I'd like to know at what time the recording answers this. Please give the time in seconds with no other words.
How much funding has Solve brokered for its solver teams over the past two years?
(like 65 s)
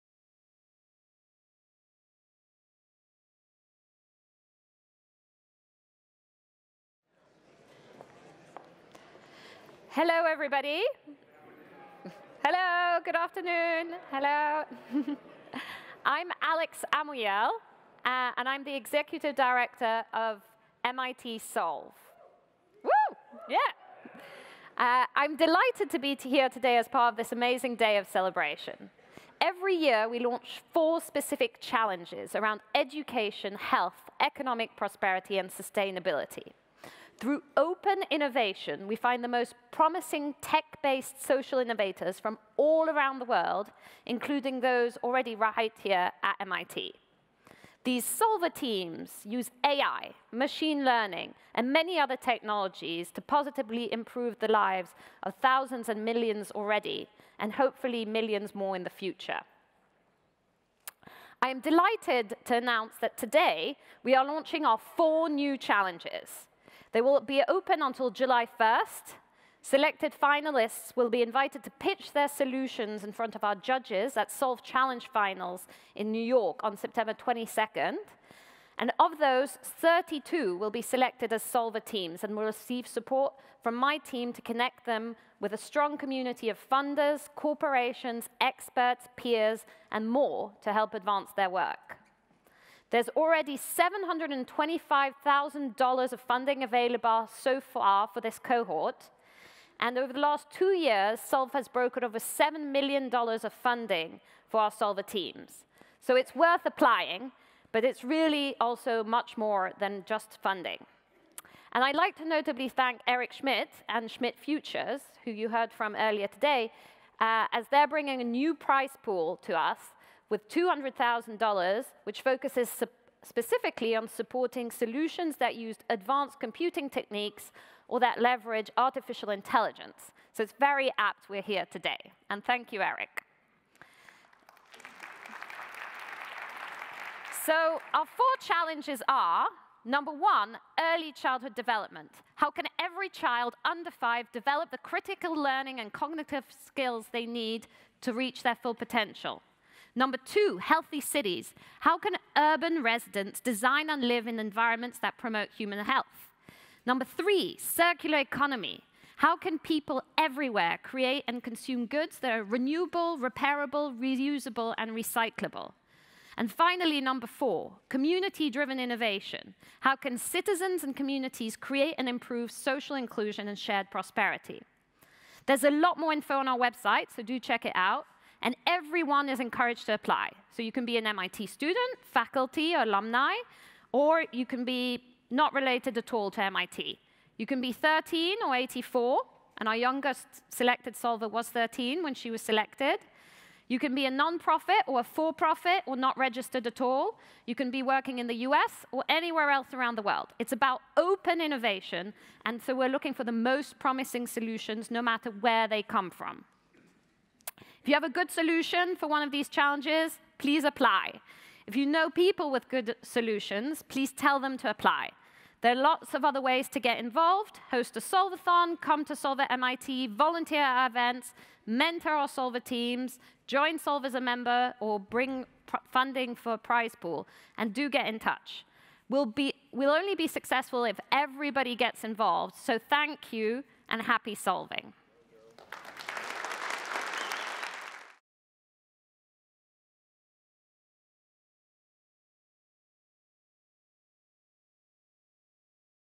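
102 s.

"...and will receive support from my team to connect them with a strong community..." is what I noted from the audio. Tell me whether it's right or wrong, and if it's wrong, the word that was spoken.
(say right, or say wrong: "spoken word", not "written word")
right.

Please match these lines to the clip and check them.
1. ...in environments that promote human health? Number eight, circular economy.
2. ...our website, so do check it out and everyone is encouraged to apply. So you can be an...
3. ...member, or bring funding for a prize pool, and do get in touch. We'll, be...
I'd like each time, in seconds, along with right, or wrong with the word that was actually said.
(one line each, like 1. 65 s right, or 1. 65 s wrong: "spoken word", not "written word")
1. 154 s wrong: "three", not "eight"
2. 176 s right
3. 224 s right.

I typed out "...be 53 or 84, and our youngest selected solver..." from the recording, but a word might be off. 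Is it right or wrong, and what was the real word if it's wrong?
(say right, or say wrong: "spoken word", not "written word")
wrong: "13", not "53".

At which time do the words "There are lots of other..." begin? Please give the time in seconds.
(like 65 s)
215 s.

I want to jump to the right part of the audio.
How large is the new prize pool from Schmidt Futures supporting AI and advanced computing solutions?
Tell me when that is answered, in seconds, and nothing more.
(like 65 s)
120 s.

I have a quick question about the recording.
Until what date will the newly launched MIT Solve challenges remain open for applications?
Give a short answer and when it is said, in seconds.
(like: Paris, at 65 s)
July 1st, at 68 s.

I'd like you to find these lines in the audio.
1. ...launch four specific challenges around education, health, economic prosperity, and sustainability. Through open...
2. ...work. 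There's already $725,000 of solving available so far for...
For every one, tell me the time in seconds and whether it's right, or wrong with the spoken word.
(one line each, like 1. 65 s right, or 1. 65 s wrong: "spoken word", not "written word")
1. 30 s right
2. 91 s wrong: "funding", not "solving".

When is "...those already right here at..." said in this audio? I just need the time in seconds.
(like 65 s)
44 s.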